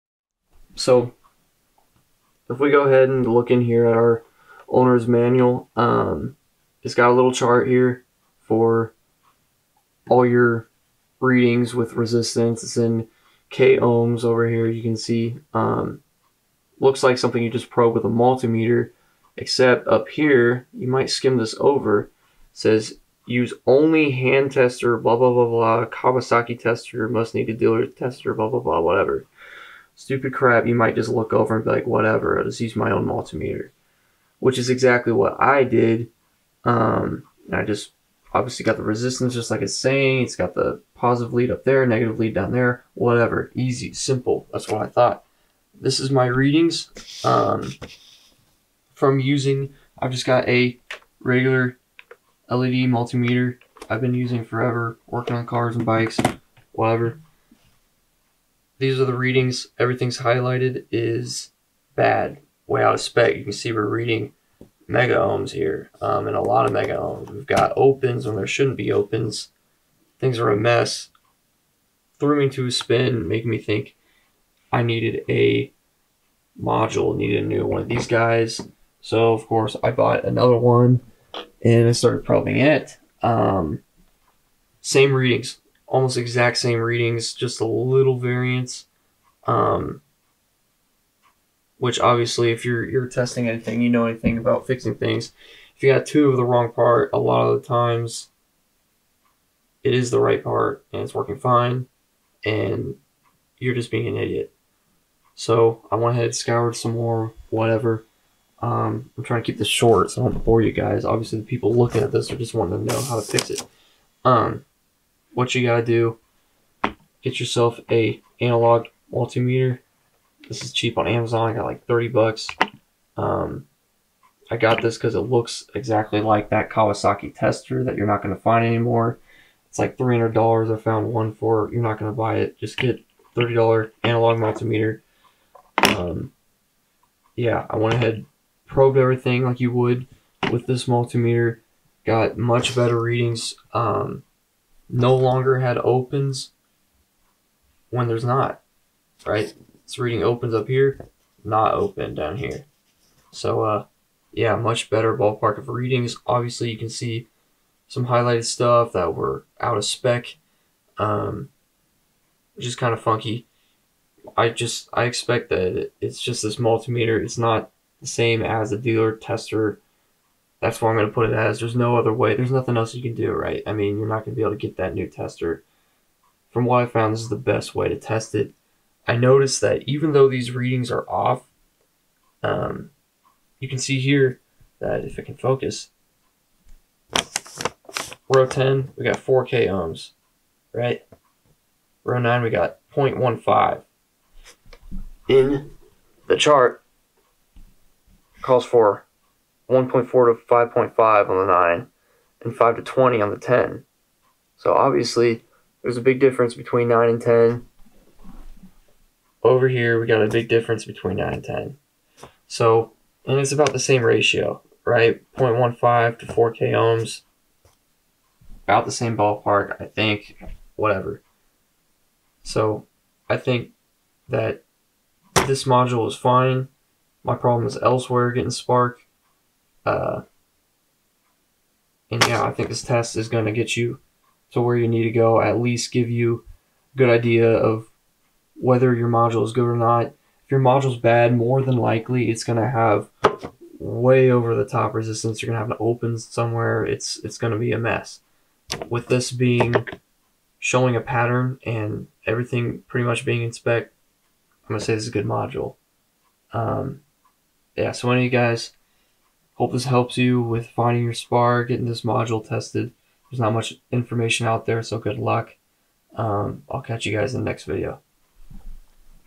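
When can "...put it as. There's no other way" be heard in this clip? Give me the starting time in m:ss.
2:51.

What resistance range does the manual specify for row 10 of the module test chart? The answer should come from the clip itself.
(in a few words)
5 to 20.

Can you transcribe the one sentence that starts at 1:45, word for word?
So I went ahead and scoured some more, whatever.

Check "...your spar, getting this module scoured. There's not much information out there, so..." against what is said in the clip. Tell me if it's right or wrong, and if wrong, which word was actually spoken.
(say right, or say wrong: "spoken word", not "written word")
wrong: "tested", not "scoured".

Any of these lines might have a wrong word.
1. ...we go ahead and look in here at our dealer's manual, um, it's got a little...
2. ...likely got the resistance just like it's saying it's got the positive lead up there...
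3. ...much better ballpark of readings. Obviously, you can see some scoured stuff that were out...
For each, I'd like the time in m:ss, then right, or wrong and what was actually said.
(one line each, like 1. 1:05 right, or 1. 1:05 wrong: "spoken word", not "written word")
1. 0:02 wrong: "owner", not "dealer"
2. 0:38 wrong: "obviously", not "likely"
3. 2:34 wrong: "highlighted", not "scoured".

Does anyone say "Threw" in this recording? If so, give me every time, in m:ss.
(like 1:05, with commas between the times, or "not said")
1:12.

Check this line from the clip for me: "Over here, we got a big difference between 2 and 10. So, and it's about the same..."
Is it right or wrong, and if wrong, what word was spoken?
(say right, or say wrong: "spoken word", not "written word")
wrong: "9", not "2".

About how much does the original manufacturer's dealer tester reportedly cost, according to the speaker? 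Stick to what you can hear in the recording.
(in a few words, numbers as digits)
$300.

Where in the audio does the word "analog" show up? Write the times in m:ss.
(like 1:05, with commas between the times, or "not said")
1:58, 2:14.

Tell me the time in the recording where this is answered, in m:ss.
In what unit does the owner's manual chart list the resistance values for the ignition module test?
0:13.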